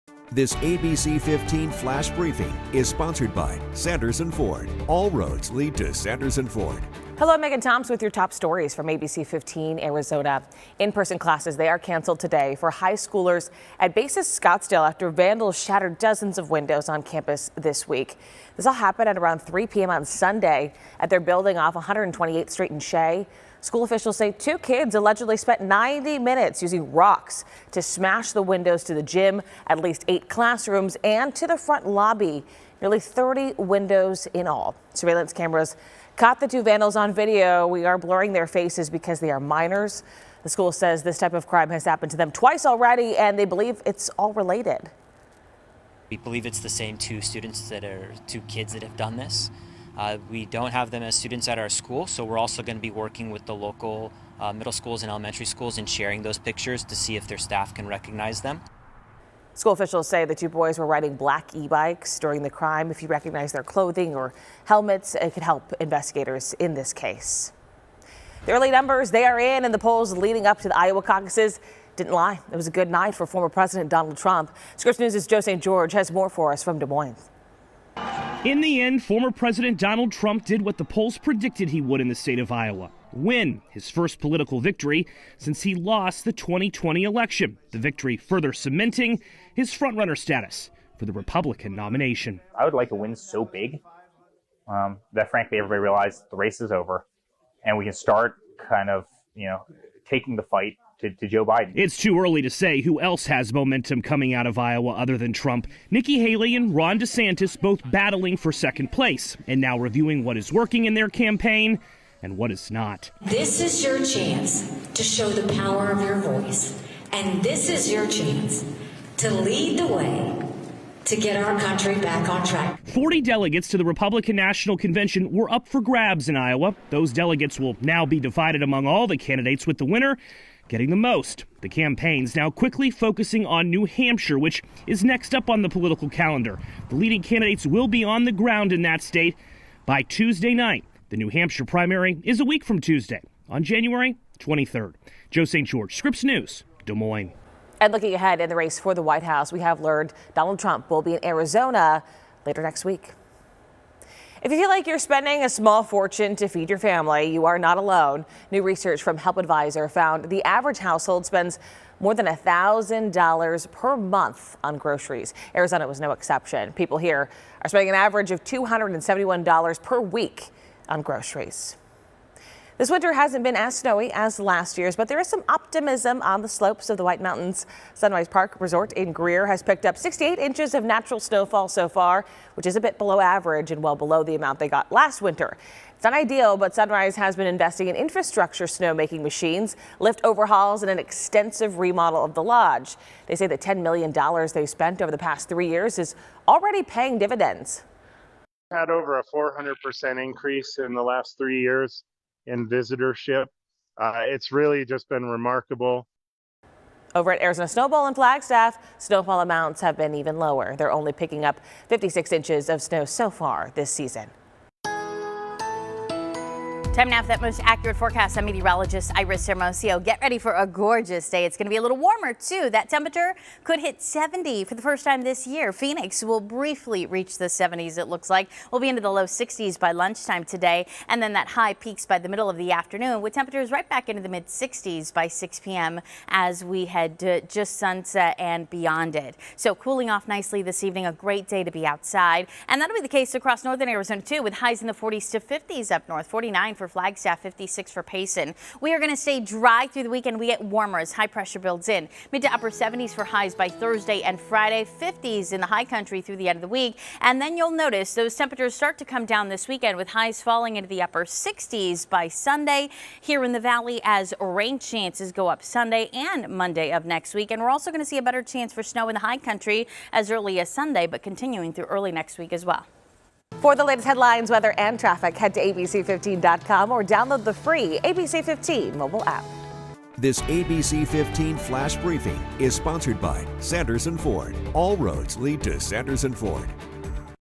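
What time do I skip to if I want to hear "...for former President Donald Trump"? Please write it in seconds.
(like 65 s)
73 s.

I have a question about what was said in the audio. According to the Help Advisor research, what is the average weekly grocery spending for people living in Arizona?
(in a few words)
$271.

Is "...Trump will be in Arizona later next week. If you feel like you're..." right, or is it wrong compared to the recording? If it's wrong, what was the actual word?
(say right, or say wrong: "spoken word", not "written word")
right.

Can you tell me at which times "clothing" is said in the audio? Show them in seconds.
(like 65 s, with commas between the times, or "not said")
63 s.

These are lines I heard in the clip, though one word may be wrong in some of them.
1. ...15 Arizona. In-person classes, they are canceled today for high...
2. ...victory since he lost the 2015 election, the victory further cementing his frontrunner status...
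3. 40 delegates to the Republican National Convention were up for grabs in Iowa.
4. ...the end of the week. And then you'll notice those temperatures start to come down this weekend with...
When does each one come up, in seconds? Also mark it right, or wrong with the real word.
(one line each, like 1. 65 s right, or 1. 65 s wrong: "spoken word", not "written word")
1. 9 s right
2. 84 s wrong: "2020", not "2015"
3. 122 s right
4. 256 s right.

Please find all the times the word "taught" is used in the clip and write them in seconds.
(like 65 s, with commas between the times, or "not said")
not said.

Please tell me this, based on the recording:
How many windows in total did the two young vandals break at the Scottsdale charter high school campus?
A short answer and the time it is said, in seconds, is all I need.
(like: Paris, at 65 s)
Nearly 30, at 32 s.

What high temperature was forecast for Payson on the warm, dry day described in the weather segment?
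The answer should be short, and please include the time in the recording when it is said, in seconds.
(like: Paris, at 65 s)
56, at 247 s.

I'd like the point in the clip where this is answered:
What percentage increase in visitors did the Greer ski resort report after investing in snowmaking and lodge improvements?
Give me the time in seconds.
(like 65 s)
199 s.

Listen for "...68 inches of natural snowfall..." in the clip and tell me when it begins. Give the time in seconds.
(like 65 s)
179 s.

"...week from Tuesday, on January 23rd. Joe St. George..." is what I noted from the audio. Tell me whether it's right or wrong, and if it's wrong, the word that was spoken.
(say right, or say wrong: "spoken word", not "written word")
right.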